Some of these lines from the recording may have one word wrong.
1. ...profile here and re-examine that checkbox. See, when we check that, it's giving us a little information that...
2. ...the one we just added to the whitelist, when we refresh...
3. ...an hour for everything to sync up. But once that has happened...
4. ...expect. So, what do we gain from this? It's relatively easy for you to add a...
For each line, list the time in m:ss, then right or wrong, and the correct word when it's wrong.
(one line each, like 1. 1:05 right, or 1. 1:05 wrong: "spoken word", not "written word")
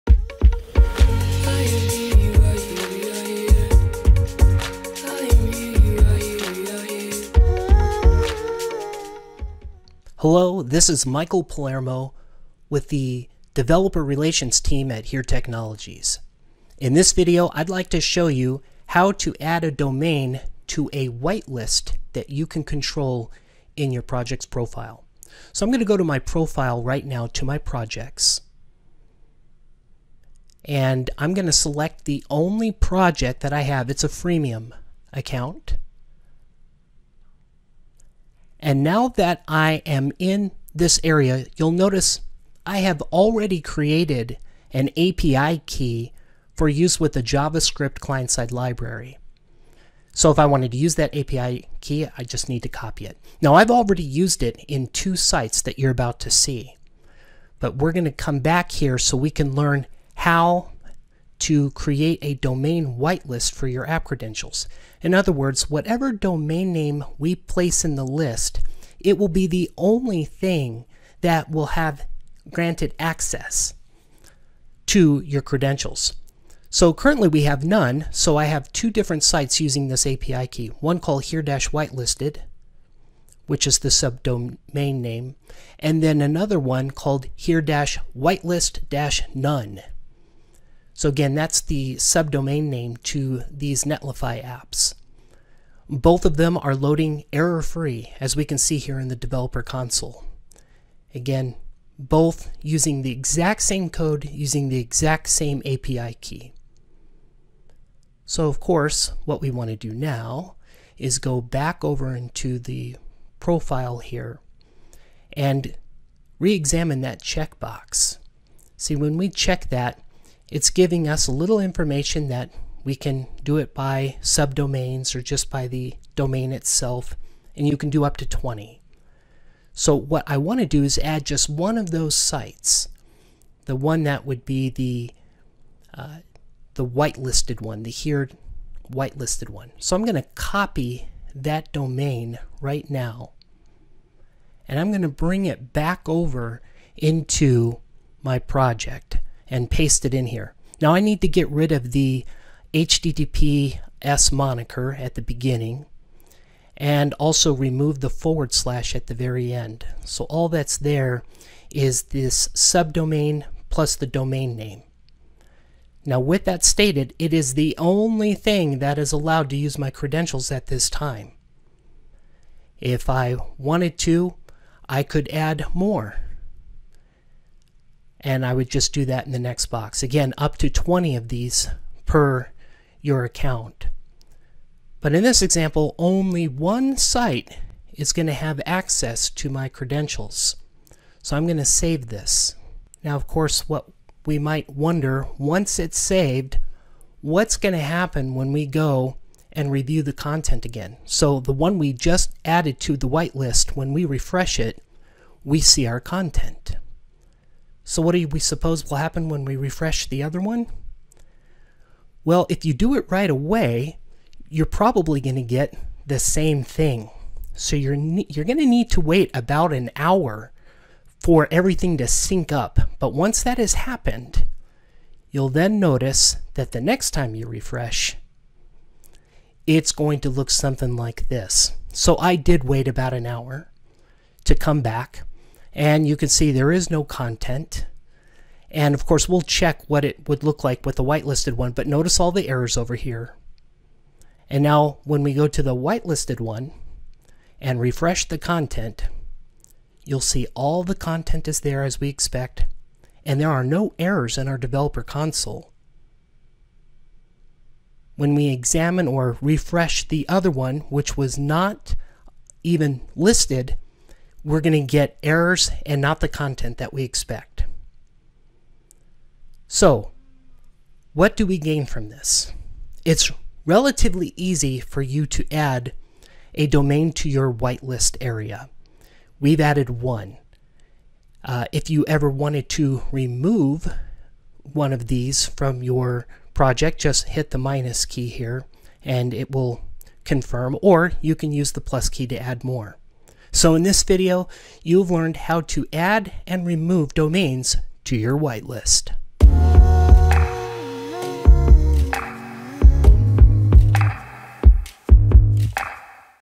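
1. 1:53 right
2. 3:21 right
3. 3:39 right
4. 4:27 right.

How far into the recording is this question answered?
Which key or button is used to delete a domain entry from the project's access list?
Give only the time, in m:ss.
4:47.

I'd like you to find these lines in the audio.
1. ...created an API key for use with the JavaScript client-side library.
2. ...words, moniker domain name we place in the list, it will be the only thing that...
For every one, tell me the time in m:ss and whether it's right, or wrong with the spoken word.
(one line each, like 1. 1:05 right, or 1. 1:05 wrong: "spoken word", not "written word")
1. 0:43 right
2. 1:05 wrong: "whatever", not "moniker".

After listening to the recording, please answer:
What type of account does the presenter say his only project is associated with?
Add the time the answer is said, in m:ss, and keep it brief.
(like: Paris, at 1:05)
Freemium, at 0:34.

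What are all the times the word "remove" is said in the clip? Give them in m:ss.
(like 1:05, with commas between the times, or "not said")
2:37, 4:43, 4:56.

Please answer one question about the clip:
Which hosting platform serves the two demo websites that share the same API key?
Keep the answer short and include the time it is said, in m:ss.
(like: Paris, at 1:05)
Netlify, at 1:33.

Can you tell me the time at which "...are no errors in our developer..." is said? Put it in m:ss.
4:13.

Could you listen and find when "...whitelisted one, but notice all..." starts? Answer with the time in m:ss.
4:01.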